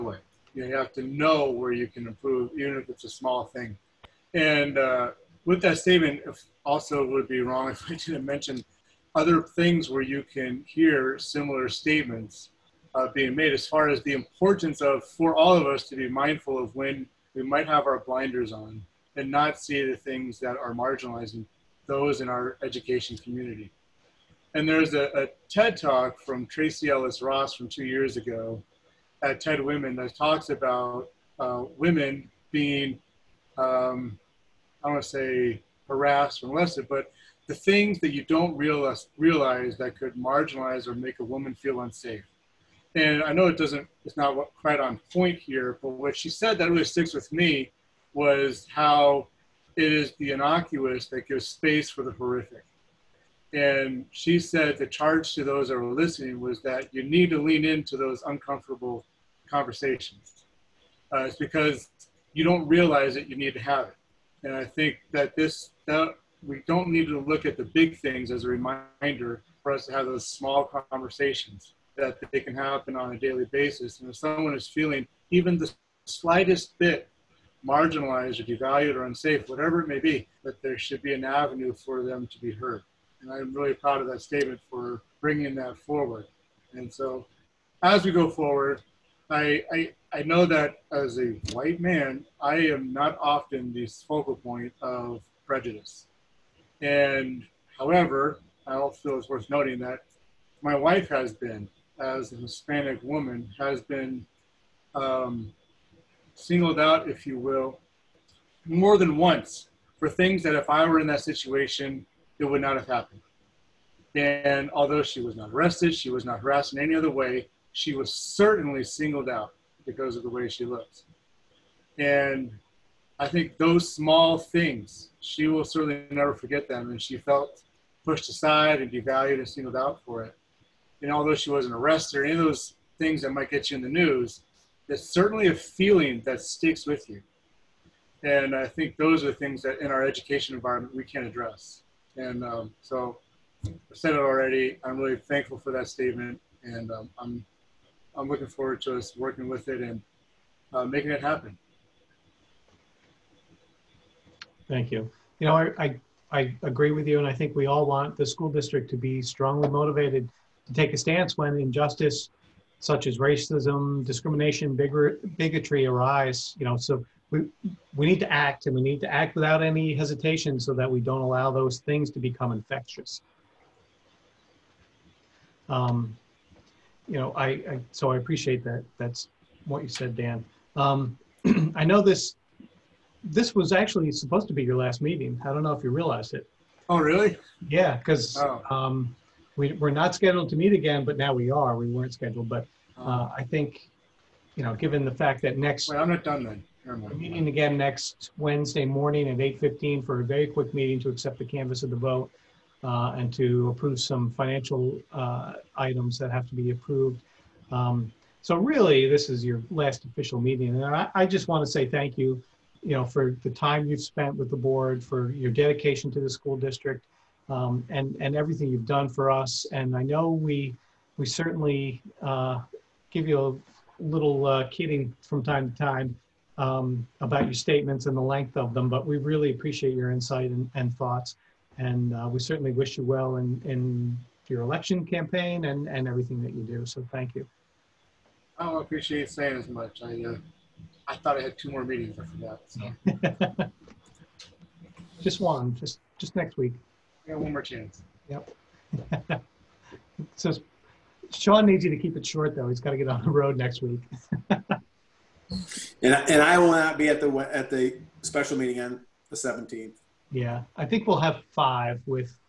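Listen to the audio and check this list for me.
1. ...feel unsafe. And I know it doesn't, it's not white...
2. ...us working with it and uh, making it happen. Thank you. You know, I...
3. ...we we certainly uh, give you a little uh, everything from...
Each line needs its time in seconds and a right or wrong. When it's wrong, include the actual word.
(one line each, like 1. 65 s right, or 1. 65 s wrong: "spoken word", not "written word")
1. 41 s wrong: "quite", not "white"
2. 148 s right
3. 220 s wrong: "kidding", not "everything".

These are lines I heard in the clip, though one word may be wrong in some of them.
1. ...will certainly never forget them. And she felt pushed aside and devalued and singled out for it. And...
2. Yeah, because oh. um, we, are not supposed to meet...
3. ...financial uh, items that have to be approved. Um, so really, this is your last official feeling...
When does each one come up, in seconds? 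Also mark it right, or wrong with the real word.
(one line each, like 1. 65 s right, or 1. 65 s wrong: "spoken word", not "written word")
1. 125 s right
2. 187 s wrong: "scheduled", not "supposed"
3. 204 s wrong: "meeting", not "feeling".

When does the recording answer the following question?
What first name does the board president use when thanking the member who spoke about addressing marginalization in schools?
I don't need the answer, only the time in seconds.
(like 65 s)
180 s.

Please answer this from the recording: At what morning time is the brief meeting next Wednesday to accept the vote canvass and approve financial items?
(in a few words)
8:15.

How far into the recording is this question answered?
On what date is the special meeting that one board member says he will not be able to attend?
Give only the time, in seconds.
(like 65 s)
259 s.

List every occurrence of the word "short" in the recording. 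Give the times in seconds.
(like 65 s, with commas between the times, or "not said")
252 s.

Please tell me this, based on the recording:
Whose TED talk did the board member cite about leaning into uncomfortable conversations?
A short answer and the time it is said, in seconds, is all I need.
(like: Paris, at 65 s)
Tracee Ellis Ross, at 26 s.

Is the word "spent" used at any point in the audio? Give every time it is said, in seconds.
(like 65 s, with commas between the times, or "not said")
214 s.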